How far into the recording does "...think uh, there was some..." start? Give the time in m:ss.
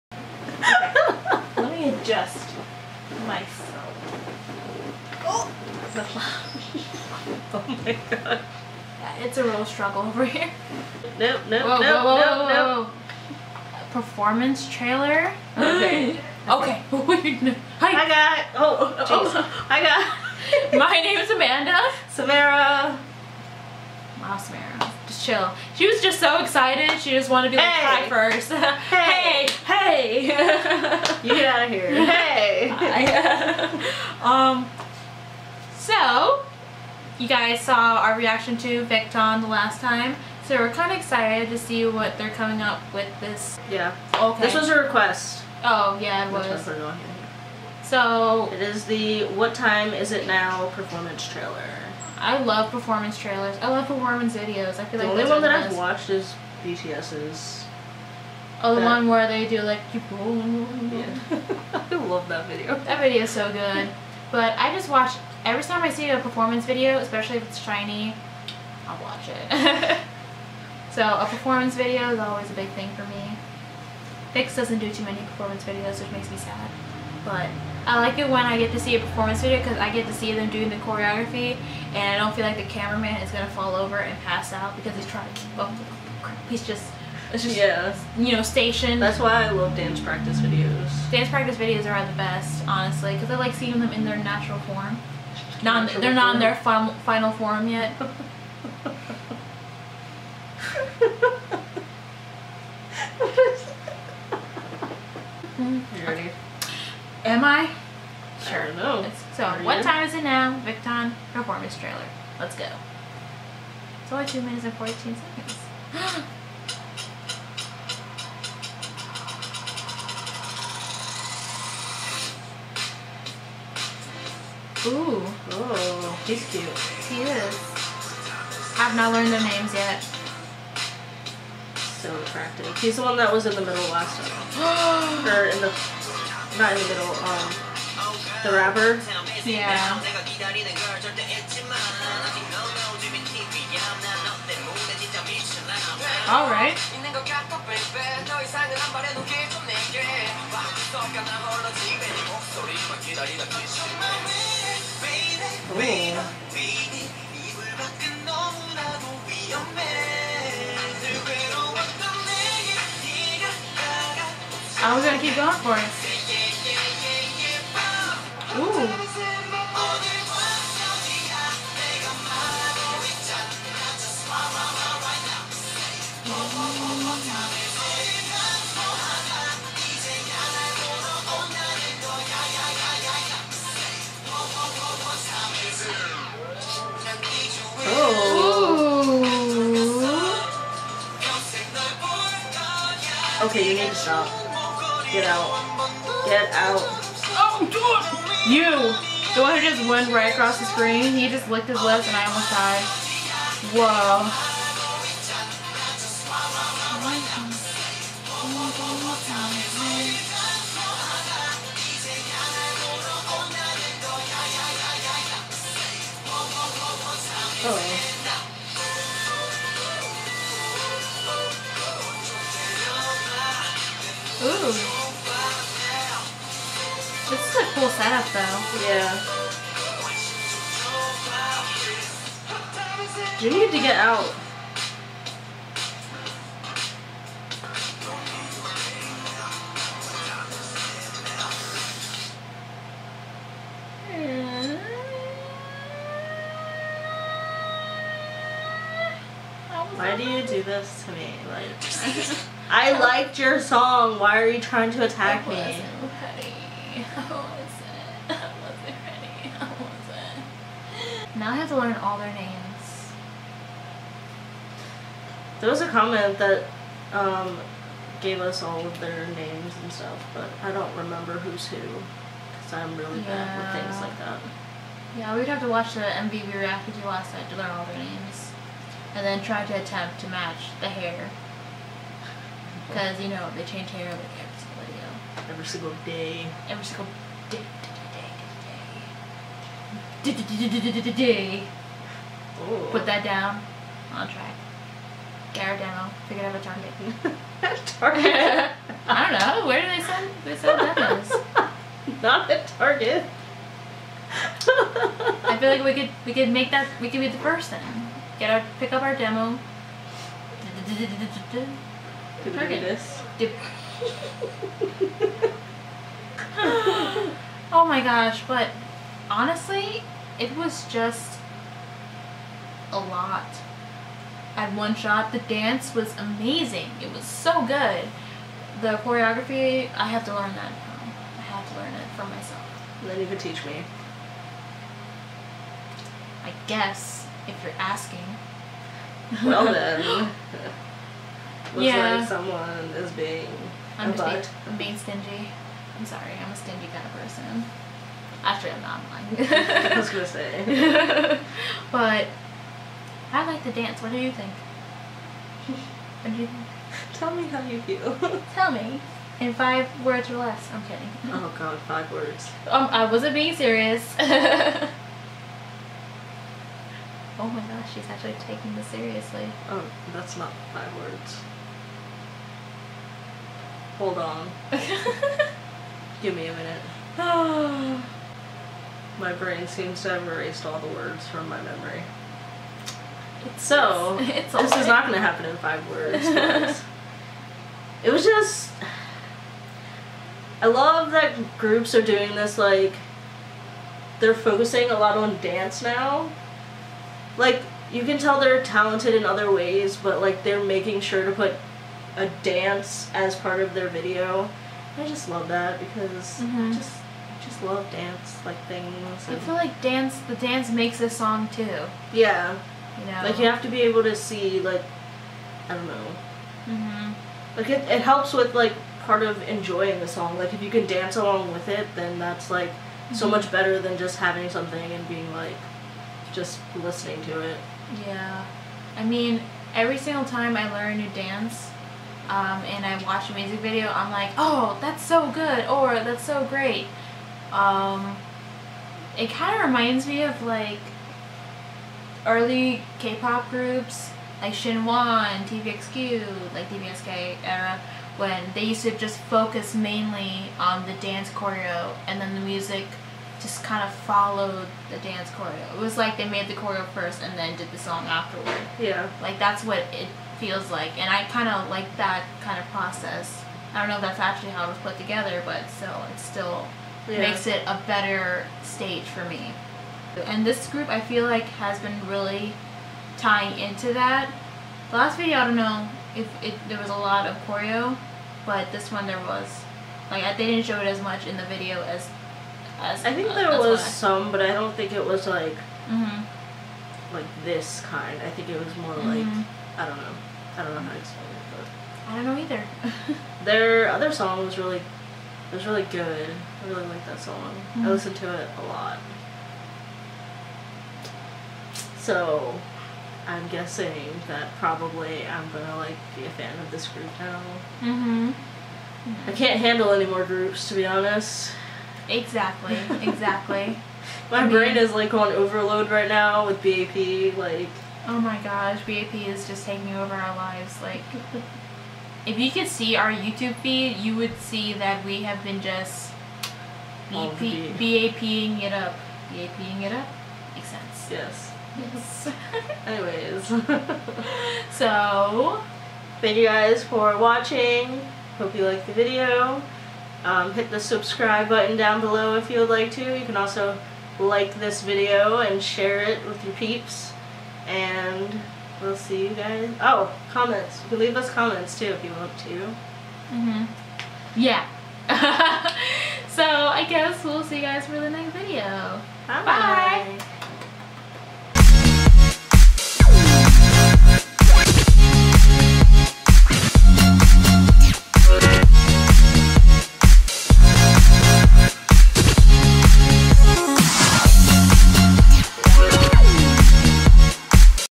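8:03.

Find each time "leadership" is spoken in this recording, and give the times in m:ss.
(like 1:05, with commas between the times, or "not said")
not said.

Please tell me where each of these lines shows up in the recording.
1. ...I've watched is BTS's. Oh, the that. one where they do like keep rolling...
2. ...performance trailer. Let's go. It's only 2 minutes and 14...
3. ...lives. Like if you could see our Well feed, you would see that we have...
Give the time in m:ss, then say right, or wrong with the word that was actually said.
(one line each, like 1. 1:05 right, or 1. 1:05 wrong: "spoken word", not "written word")
1. 0:55 right
2. 1:51 right
3. 8:40 wrong: "YouTube", not "Well".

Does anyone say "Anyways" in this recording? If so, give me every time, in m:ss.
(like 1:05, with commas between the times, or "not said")
8:52.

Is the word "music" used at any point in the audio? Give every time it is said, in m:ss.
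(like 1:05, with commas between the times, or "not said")
7:13, 7:32.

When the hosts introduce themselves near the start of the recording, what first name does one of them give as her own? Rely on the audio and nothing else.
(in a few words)
Amanda.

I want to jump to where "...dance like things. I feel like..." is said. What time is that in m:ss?
6:47.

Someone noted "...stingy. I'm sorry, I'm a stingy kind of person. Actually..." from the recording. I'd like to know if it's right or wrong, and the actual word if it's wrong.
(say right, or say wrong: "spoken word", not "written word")
right.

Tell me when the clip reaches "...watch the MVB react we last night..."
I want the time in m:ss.
4:35.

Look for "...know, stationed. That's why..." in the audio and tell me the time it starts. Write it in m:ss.
1:28.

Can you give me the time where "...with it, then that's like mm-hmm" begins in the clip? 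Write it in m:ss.
7:01.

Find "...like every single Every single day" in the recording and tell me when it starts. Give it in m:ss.
4:44.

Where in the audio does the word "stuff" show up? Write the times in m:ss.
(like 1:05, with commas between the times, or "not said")
4:29.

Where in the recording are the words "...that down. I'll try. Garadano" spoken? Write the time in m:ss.
4:53.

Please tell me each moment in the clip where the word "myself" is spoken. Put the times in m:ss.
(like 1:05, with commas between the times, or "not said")
0:03, 5:32.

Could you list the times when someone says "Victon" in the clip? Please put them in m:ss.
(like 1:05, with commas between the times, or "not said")
0:38, 1:50.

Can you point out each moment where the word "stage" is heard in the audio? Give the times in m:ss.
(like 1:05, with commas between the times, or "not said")
7:48.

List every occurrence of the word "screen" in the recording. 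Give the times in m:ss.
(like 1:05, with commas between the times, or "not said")
3:20.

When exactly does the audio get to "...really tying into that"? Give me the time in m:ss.
7:52.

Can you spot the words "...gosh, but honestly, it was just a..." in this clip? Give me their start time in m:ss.
5:18.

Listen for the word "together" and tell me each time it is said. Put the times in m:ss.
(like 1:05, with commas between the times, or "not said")
7:44.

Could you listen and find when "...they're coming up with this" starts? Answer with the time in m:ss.
0:42.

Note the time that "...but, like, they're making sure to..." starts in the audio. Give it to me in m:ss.
6:39.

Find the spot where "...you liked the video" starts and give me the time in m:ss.
8:58.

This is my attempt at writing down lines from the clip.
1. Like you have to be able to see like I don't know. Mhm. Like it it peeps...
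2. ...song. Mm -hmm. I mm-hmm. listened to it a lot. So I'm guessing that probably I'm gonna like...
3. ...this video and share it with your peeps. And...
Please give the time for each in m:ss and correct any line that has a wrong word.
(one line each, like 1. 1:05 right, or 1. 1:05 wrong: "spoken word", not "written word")
1. 6:53 wrong: "helps", not "peeps"
2. 8:17 right
3. 9:04 right.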